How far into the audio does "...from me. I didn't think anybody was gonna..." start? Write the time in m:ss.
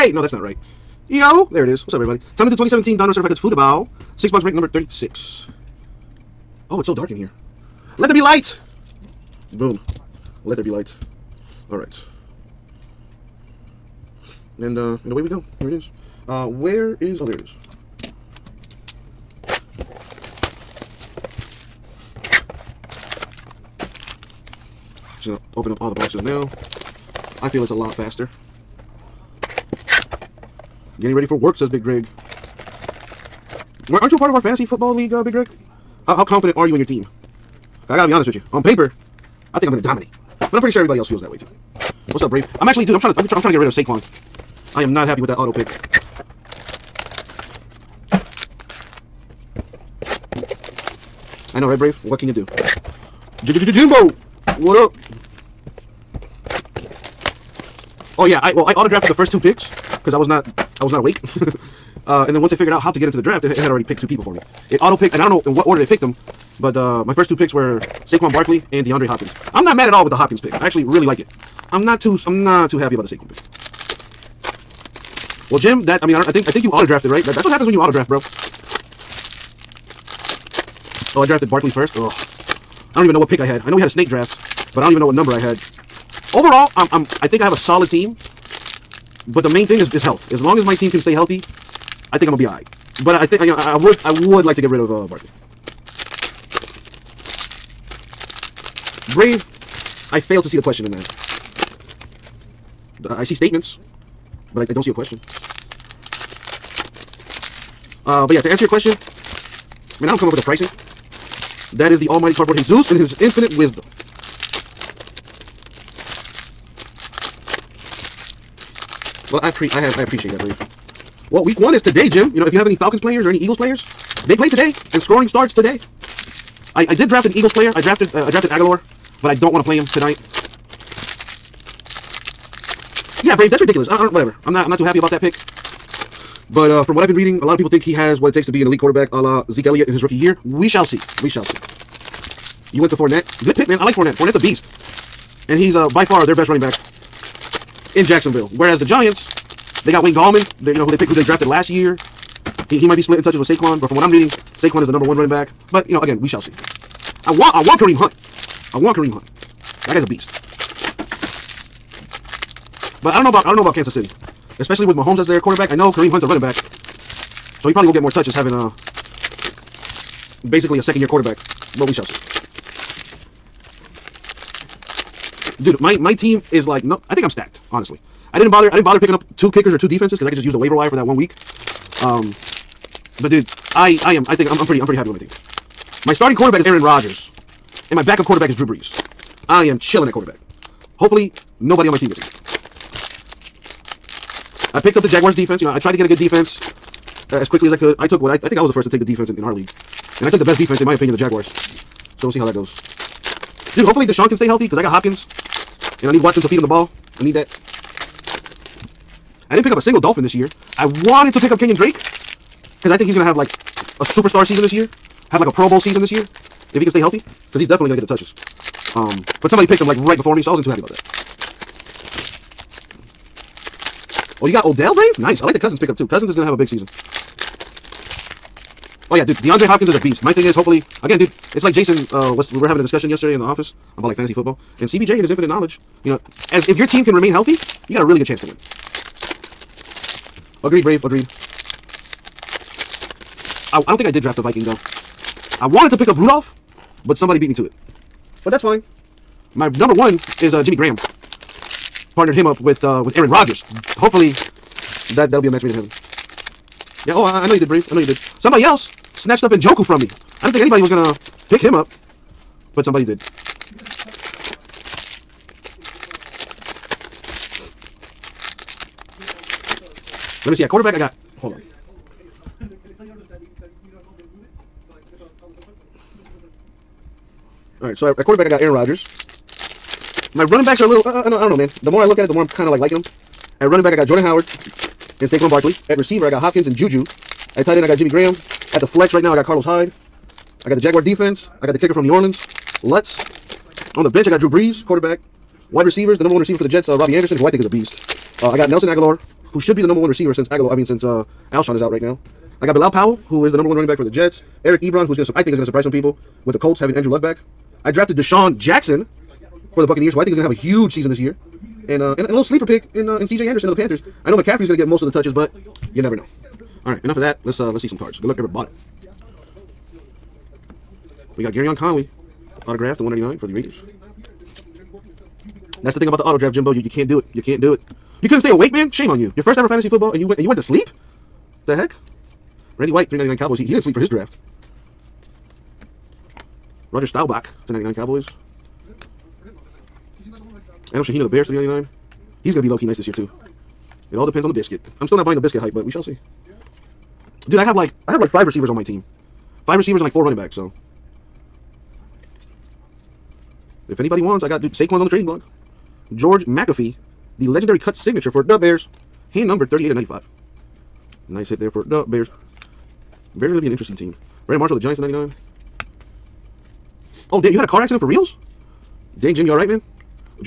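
4:19.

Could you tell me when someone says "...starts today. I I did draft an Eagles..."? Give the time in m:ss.
2:05.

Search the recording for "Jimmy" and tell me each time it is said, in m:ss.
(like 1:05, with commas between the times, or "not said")
4:10, 4:47.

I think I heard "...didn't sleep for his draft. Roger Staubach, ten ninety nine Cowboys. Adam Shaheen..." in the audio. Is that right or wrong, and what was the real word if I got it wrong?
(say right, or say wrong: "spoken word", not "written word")
right.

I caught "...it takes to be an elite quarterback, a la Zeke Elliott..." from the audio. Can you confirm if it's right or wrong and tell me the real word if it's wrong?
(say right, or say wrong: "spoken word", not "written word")
right.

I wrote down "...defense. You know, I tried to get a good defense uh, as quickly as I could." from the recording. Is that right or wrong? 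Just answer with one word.
right.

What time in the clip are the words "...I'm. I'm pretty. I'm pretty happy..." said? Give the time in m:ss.
3:04.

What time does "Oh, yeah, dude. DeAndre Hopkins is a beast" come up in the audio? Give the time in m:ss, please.
3:49.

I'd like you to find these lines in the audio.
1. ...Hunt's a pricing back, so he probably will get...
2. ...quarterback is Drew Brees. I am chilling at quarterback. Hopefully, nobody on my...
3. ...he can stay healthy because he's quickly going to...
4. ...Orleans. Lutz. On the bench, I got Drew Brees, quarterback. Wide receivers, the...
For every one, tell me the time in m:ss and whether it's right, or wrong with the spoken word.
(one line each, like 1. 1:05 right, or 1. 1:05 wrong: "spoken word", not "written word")
1. 2:46 wrong: "running", not "pricing"
2. 3:08 right
3. 3:36 wrong: "definitely", not "quickly"
4. 4:52 right.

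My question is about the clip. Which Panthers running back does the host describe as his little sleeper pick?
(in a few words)
C.J. Anderson.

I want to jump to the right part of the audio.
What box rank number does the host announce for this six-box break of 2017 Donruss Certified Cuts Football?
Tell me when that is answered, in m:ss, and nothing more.
0:04.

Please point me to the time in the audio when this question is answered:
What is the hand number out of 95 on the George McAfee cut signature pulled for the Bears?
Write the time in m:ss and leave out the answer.
5:59.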